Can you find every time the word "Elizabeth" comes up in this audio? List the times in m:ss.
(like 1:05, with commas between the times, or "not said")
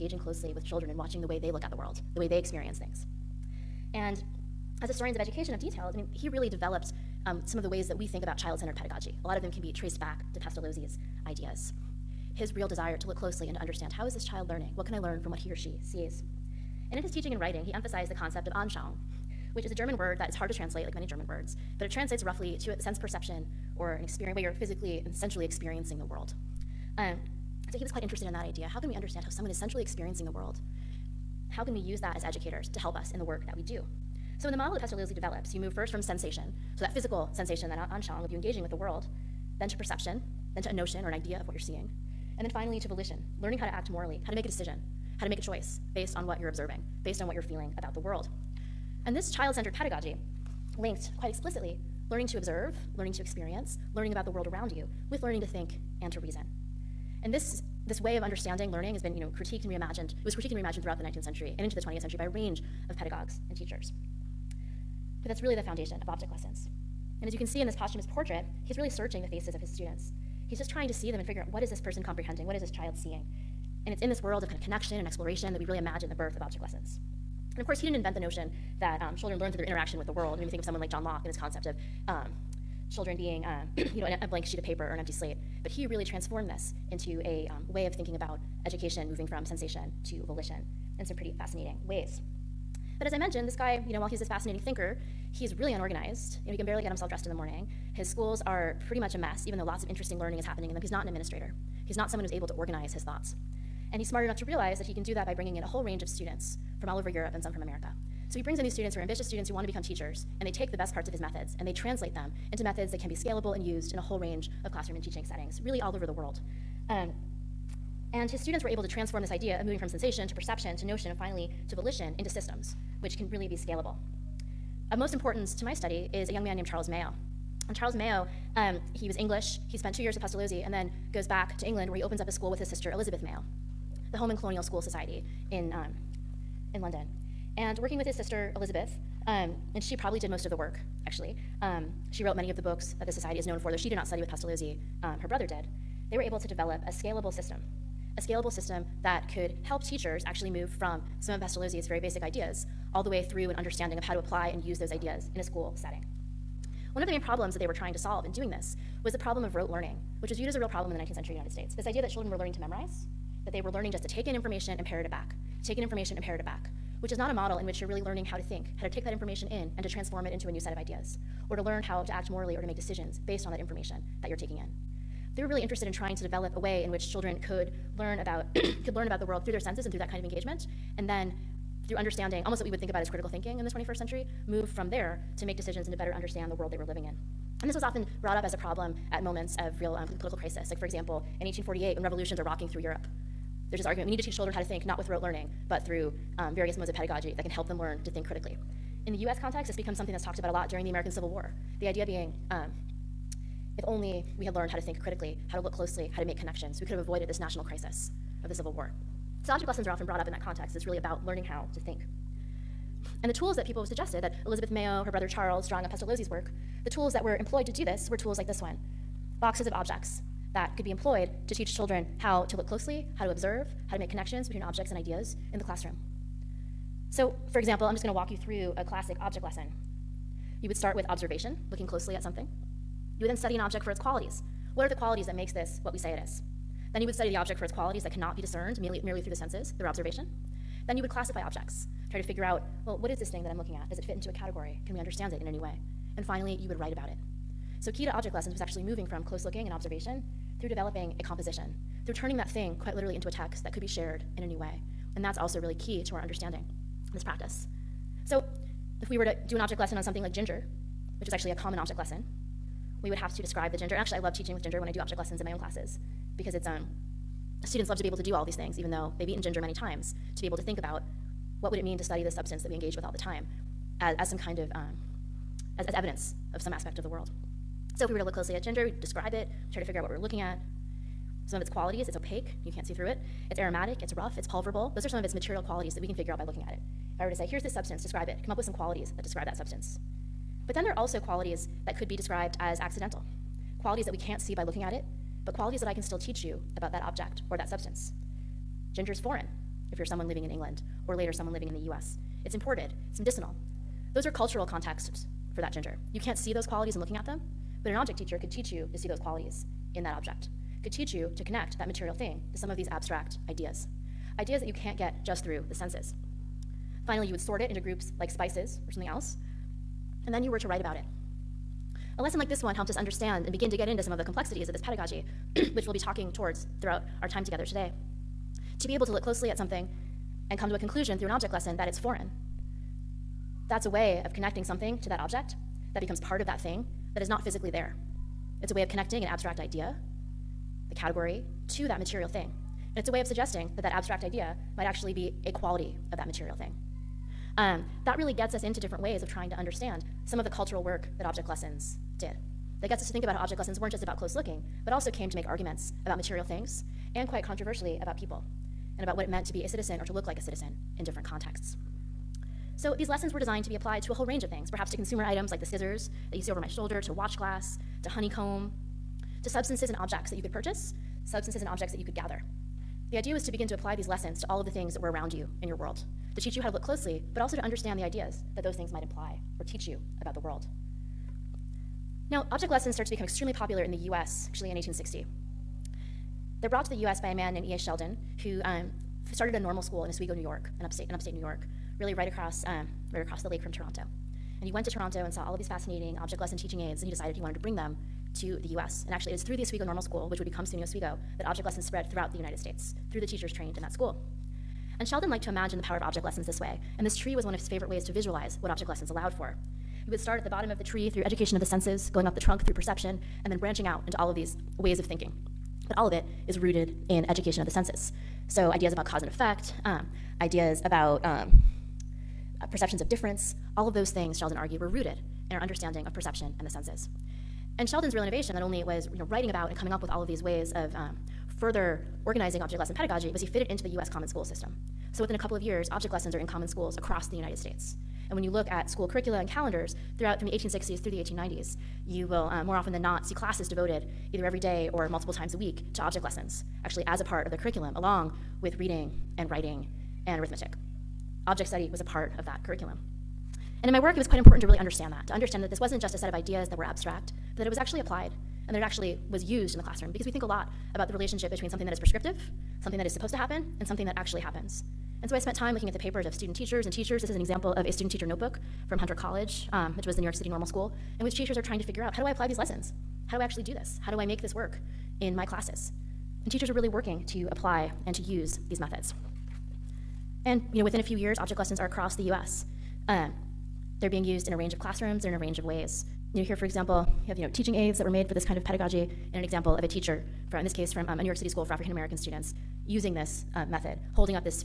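2:12, 2:18, 3:34.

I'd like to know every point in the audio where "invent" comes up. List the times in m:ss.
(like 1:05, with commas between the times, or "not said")
1:17.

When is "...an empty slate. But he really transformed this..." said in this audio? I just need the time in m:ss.
1:24.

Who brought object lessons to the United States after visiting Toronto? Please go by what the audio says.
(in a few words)
E.A. Sheldon.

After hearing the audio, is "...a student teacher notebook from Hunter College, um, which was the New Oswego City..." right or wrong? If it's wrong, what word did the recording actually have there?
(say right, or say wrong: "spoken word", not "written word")
wrong: "York", not "Oswego".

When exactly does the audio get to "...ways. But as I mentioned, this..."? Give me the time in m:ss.
1:31.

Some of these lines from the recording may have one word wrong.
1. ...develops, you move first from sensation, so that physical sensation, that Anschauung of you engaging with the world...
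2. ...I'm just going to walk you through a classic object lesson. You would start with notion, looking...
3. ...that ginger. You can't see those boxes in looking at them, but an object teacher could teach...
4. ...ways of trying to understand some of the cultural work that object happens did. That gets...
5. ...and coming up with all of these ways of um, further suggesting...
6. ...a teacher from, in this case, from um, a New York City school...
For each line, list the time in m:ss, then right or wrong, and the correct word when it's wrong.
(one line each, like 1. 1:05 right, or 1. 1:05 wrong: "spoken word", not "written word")
1. 0:35 right
2. 3:47 wrong: "observation", not "notion"
3. 5:05 wrong: "qualities", not "boxes"
4. 5:49 wrong: "lessons", not "happens"
5. 7:09 wrong: "organizing", not "suggesting"
6. 8:09 right.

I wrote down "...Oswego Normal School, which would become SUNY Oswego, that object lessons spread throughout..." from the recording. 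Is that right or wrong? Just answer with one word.
right.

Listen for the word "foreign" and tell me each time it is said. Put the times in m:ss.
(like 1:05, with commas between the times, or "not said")
4:59, 5:31.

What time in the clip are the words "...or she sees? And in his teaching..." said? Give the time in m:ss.
0:15.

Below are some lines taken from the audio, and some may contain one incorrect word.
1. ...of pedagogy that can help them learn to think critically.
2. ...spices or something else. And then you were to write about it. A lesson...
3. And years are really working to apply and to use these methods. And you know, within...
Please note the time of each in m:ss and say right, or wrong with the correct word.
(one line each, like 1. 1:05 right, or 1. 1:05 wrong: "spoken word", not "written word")
1. 3:16 right
2. 5:18 right
3. 7:56 wrong: "teachers", not "years".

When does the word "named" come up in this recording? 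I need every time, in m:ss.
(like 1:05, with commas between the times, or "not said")
2:06, 6:27.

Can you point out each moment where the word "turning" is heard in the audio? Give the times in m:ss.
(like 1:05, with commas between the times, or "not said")
4:12.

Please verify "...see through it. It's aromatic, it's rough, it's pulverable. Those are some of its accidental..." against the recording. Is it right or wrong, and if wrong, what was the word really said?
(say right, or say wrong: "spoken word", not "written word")
wrong: "material", not "accidental".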